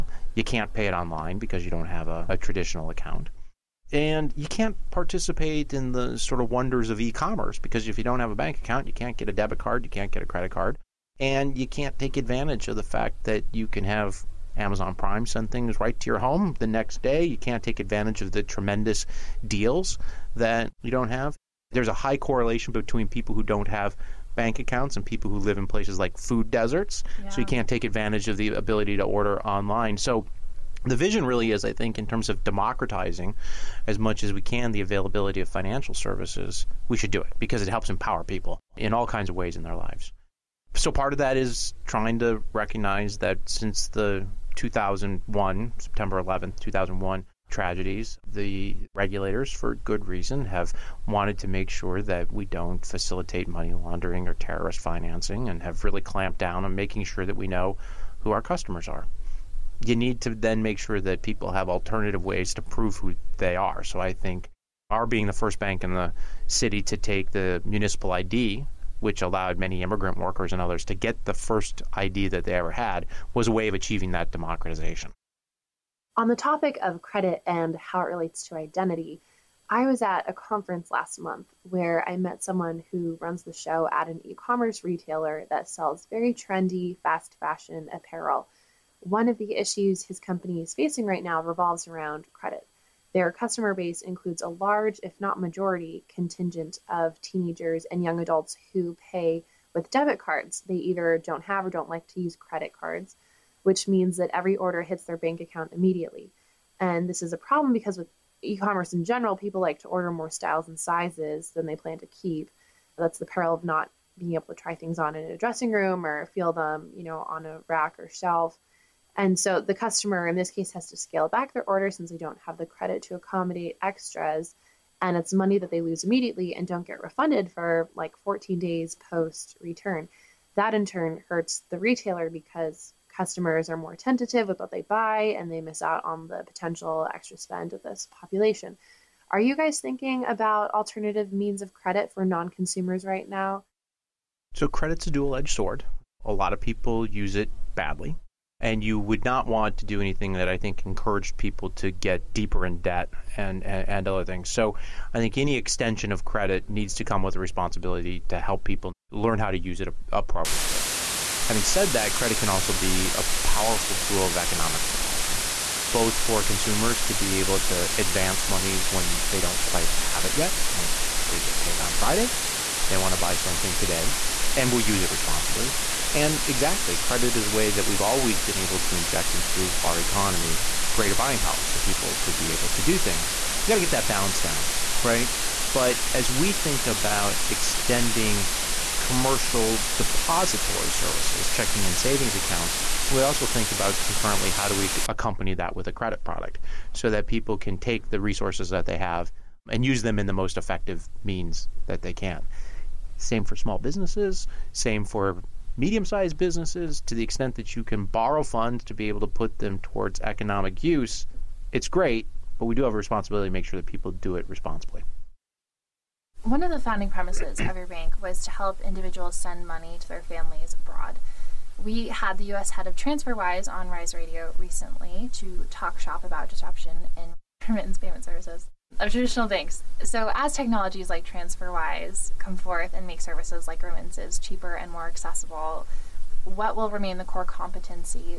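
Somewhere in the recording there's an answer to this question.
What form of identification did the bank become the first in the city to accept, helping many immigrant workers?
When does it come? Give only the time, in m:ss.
1:07.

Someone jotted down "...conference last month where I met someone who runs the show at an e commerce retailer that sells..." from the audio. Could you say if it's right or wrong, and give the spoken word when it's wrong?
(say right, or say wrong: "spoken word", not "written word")
right.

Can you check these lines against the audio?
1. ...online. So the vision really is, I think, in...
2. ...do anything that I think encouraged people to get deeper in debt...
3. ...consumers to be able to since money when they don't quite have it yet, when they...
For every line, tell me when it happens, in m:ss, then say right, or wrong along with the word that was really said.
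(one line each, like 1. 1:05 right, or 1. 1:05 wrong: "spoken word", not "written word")
1. 0:29 right
2. 2:29 right
3. 2:46 wrong: "advance", not "since".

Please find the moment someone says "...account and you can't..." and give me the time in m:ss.
0:02.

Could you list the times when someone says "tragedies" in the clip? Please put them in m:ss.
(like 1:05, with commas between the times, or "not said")
0:47.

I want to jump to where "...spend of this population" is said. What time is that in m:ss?
2:17.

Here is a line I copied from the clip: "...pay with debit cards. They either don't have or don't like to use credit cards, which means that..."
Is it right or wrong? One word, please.
right.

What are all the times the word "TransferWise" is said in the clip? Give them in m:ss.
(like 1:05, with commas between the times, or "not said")
3:42, 3:51.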